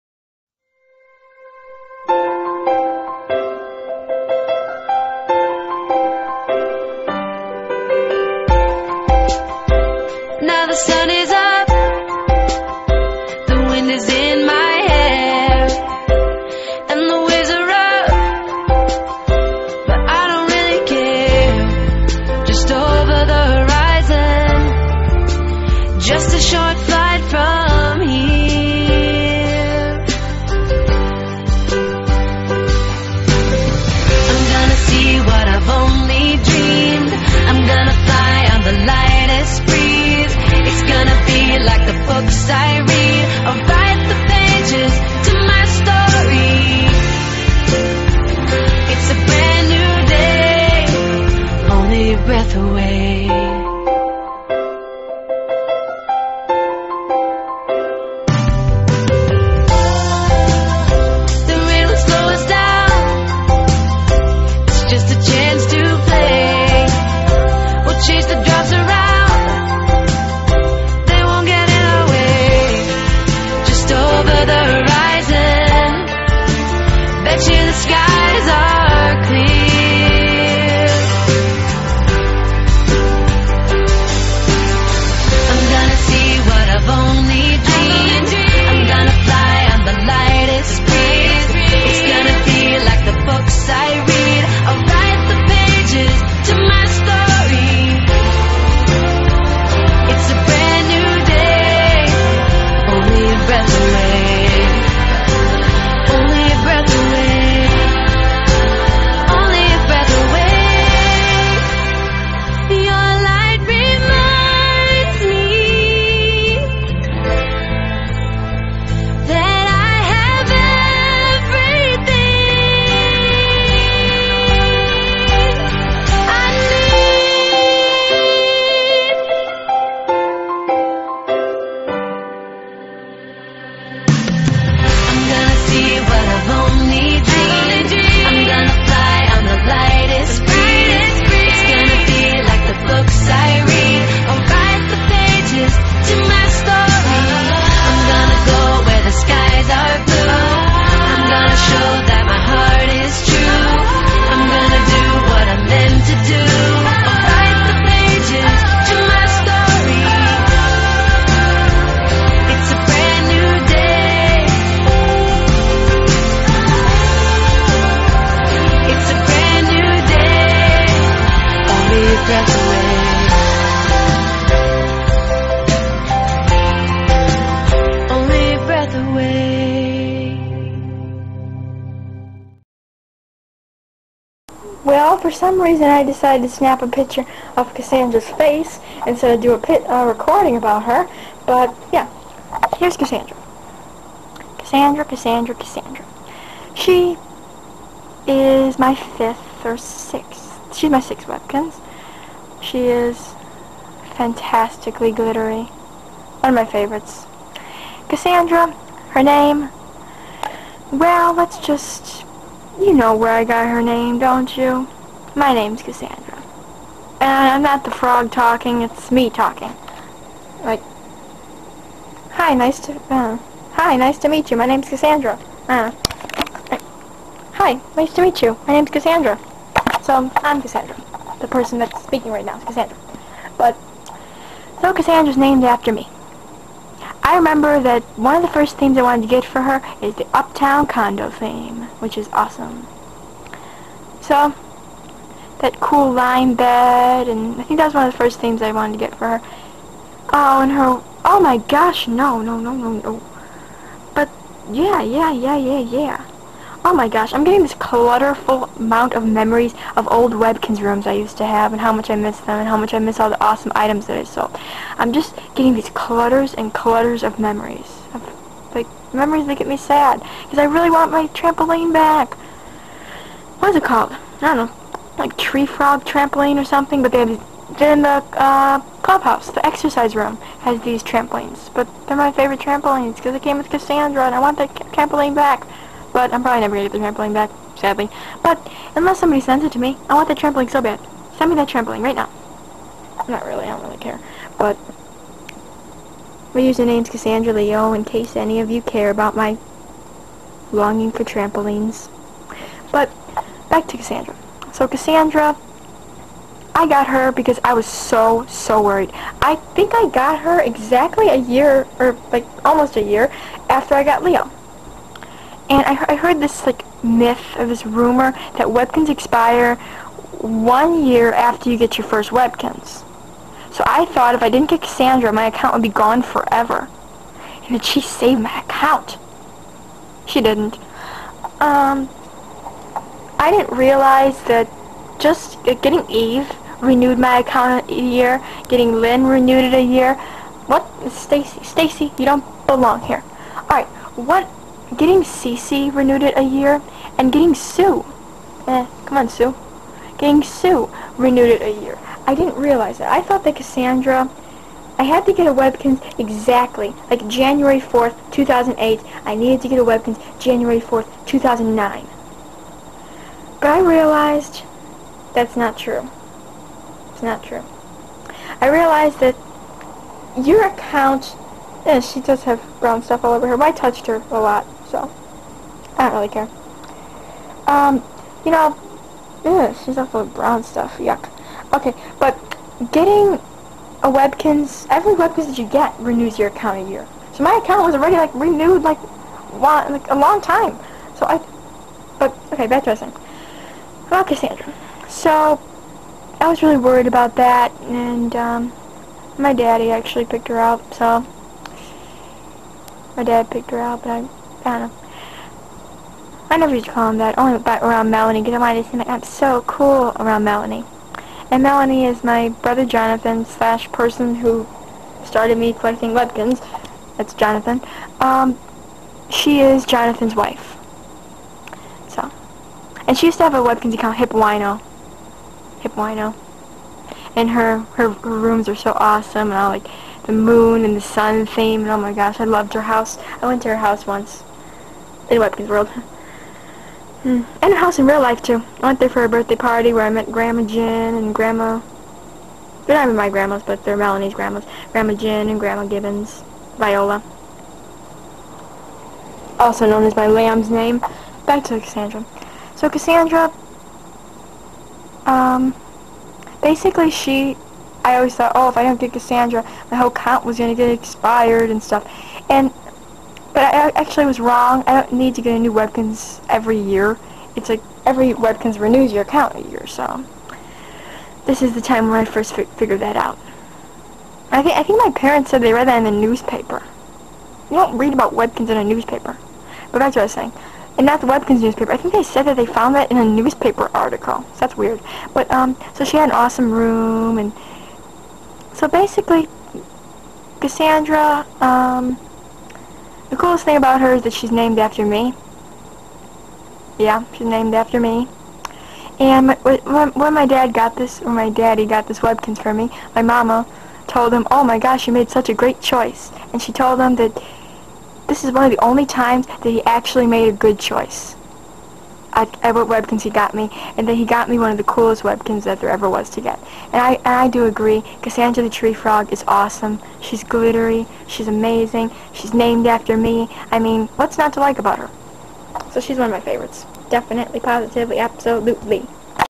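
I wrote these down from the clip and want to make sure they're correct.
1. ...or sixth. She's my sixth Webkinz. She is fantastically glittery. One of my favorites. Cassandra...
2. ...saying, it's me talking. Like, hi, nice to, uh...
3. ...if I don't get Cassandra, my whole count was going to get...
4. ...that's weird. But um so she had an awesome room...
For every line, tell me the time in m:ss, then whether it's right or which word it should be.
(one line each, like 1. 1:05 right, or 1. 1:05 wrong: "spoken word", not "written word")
1. 3:19 right
2. 3:38 wrong: "talking", not "saying"
3. 7:38 right
4. 8:04 right.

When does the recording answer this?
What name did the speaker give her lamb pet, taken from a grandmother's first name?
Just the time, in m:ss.
7:26.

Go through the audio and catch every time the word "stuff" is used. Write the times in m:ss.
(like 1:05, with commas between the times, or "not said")
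6:13, 6:20, 7:41.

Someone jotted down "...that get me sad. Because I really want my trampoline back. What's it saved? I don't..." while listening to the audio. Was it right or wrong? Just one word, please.
wrong.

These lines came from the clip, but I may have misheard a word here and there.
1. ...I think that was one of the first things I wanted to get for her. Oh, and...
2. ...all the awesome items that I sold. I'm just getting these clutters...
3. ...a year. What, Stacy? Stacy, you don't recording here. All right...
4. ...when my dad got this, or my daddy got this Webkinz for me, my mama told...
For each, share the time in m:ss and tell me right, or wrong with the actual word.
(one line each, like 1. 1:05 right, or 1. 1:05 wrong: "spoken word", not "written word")
1. 4:07 right
2. 4:23 right
3. 5:39 wrong: "belong", not "recording"
4. 8:20 right.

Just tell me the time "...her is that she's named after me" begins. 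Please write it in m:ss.
8:14.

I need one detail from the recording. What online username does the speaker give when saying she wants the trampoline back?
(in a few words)
Cassandra Leo.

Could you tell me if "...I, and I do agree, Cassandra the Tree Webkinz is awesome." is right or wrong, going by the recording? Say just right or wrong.
wrong.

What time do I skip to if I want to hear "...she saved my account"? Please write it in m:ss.
5:27.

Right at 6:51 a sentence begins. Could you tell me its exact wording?
And Melanie is my brother Jonathan slash person who started me collecting Webkinz.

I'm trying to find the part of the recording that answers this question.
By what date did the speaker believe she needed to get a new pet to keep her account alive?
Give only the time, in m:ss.
6:00.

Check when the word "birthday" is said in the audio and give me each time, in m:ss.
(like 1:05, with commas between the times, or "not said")
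7:19.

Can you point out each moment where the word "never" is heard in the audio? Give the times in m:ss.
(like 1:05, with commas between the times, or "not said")
4:46, 6:46.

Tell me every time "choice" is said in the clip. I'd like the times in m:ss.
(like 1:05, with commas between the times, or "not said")
8:25, 8:30.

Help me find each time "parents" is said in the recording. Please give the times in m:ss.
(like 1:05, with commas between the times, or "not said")
7:55.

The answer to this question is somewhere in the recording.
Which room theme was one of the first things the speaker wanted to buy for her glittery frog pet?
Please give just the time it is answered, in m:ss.
4:00.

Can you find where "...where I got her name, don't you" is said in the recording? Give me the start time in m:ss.
3:33.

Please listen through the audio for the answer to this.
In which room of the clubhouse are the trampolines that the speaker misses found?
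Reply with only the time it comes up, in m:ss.
4:39.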